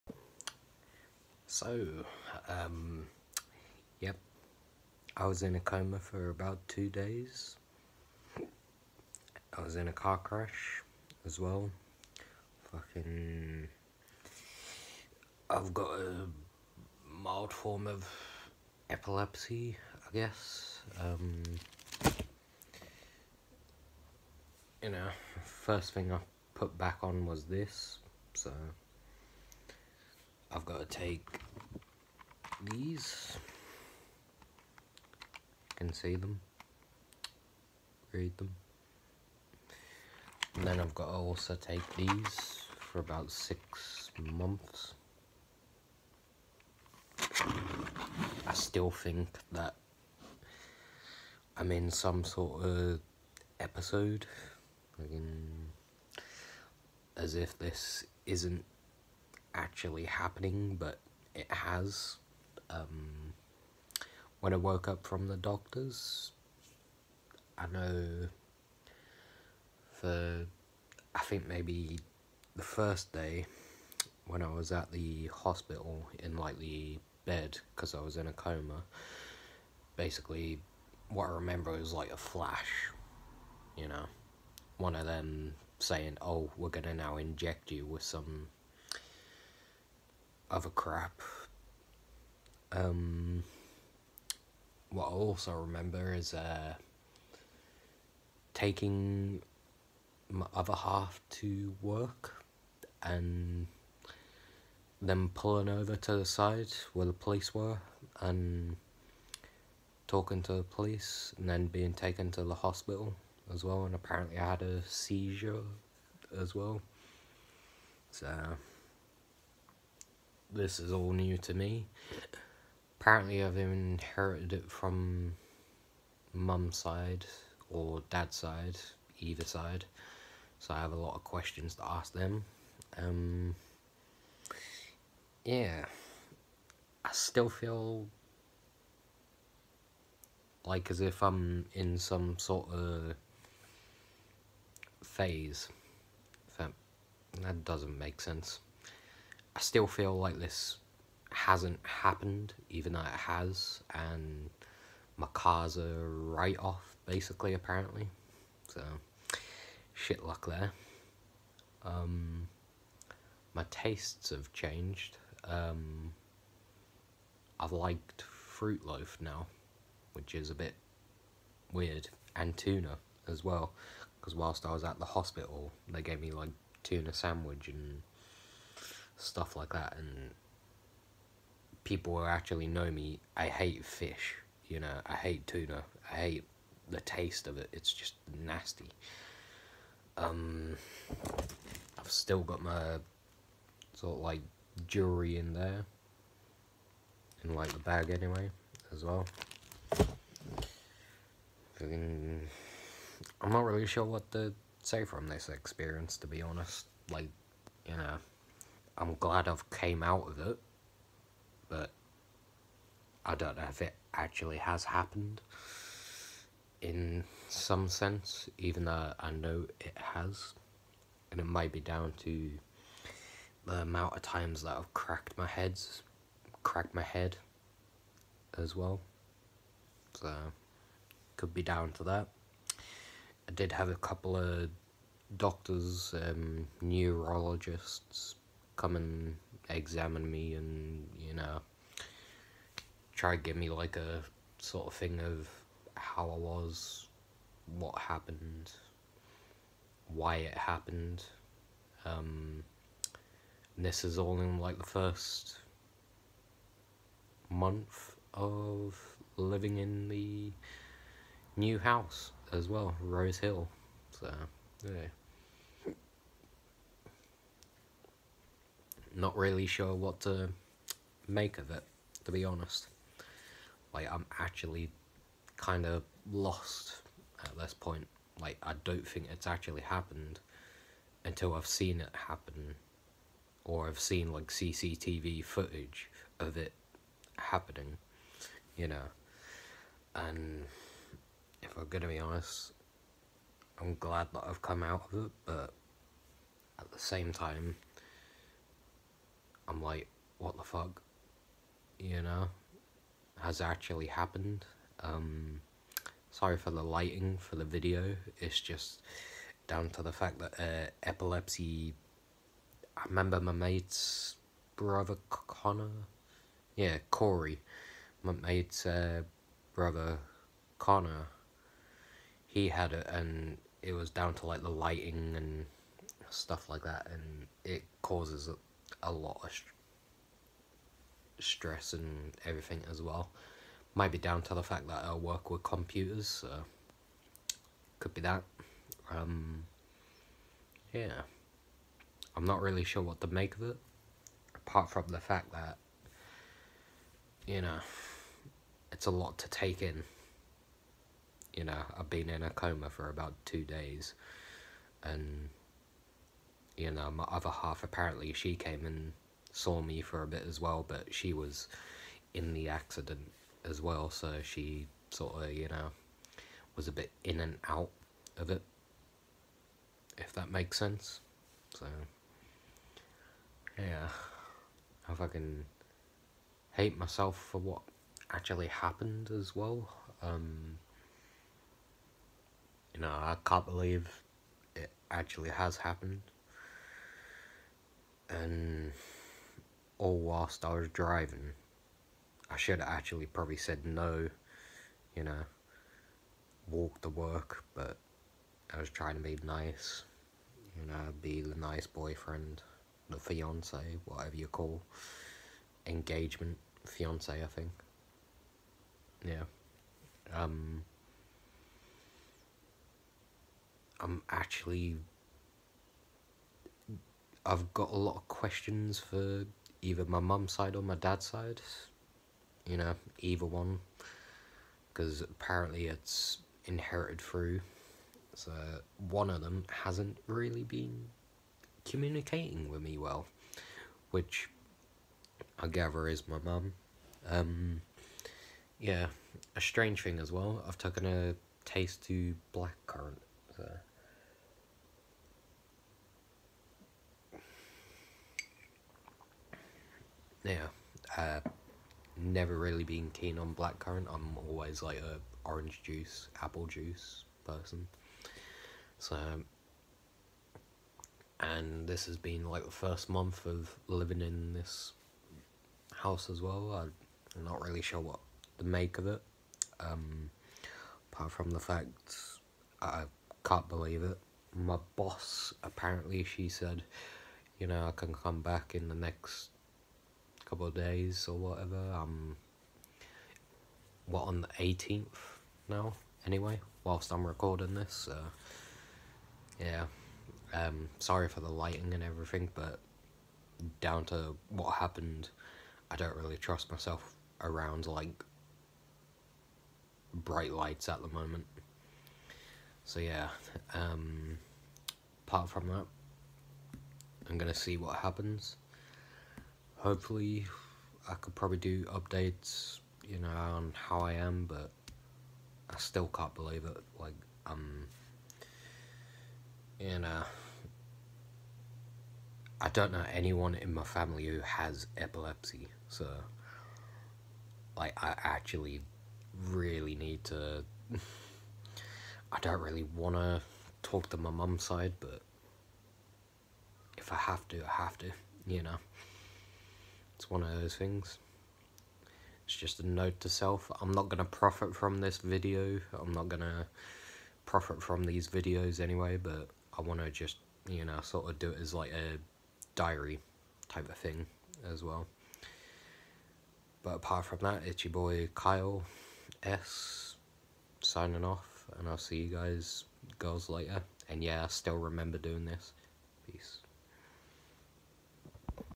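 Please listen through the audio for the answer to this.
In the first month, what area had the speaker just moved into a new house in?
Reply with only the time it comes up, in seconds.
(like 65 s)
262 s.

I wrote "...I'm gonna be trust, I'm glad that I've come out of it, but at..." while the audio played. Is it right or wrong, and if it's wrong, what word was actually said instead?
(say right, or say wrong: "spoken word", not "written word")
wrong: "honest", not "trust".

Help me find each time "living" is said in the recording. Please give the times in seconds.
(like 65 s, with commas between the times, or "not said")
259 s, 463 s.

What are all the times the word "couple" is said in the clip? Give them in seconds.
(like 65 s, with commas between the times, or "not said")
233 s, 480 s.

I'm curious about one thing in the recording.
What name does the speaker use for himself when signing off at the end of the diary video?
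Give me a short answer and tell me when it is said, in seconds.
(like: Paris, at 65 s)
Kyle S, at 558 s.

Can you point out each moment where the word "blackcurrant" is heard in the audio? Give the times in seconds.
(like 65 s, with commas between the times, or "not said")
442 s, 453 s.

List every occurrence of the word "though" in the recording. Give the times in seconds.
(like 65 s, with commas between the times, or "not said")
152 s, 218 s.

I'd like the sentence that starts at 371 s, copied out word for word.
So, yeah, I fucking hate myself for what actually happened as well.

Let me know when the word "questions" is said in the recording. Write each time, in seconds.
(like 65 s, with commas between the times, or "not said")
131 s, 418 s.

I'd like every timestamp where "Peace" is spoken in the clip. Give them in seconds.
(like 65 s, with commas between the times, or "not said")
566 s.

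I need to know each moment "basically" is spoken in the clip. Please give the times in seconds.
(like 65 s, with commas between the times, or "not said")
79 s, 157 s.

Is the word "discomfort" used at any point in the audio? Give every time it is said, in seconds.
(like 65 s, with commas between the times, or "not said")
not said.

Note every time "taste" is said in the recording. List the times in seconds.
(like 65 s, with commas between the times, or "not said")
163 s, 187 s, 441 s.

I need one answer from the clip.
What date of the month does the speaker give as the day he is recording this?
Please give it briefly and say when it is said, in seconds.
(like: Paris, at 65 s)
18th, at 484 s.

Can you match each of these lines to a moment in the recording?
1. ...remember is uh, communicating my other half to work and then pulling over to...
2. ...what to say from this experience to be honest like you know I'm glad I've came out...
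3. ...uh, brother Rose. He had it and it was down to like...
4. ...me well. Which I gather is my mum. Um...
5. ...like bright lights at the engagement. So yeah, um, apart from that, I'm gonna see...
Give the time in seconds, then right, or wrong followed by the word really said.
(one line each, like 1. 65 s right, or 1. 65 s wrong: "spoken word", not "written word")
1. 95 s wrong: "taking", not "communicating"
2. 204 s right
3. 318 s wrong: "Connor", not "Rose"
4. 432 s right
5. 497 s wrong: "moment", not "engagement".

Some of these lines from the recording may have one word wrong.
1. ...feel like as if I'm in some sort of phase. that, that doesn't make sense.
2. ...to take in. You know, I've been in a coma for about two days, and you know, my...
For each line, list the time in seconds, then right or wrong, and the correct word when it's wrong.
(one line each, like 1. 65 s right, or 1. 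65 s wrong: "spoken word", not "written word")
1. 137 s right
2. 349 s right.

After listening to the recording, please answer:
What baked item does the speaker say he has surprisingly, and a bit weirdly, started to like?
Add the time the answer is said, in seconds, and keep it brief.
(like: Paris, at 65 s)
Fruit Loaf, at 168 s.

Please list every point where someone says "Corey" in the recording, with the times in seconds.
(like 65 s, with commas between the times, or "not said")
317 s.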